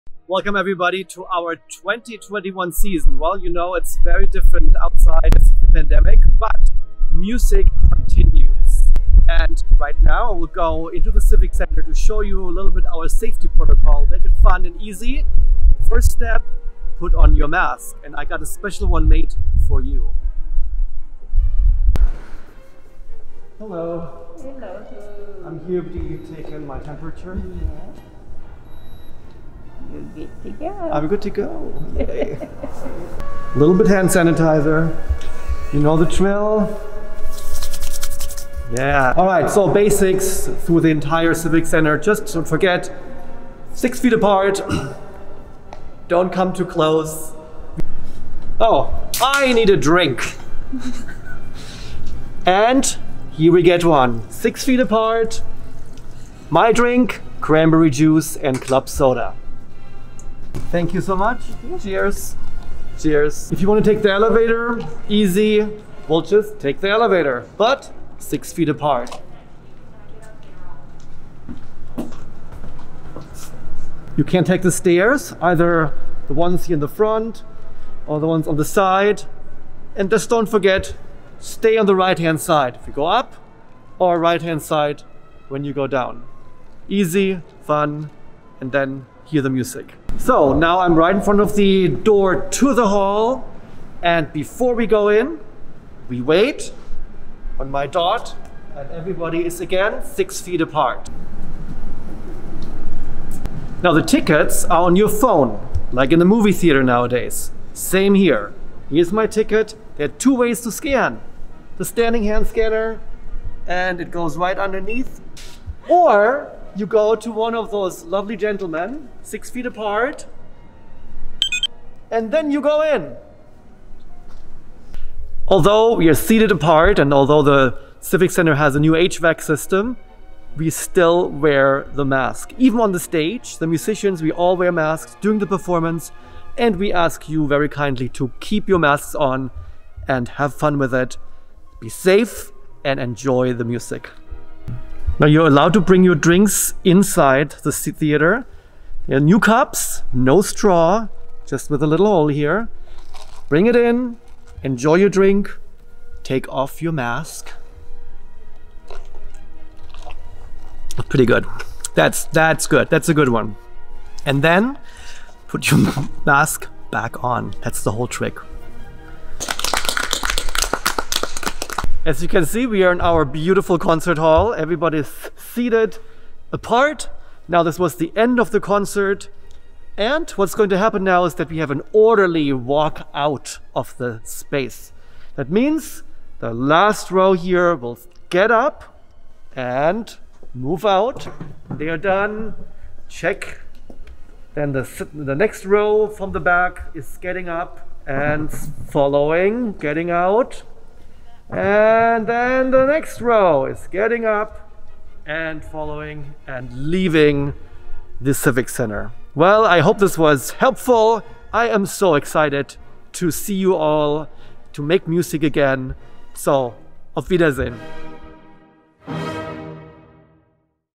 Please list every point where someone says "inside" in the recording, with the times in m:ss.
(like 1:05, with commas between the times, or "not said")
2:26.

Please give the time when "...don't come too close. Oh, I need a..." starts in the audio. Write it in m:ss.
0:46.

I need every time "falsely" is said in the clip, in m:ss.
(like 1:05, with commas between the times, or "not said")
not said.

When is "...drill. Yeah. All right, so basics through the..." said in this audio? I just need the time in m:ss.
0:36.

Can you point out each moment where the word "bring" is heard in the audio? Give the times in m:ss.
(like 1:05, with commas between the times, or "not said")
2:25, 2:33.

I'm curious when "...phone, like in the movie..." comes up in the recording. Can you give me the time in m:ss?
1:45.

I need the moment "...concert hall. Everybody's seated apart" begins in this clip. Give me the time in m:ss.
2:53.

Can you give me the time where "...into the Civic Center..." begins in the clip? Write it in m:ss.
0:10.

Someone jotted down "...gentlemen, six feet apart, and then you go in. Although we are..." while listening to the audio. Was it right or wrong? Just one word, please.
right.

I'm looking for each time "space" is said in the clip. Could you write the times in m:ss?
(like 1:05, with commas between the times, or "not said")
3:04.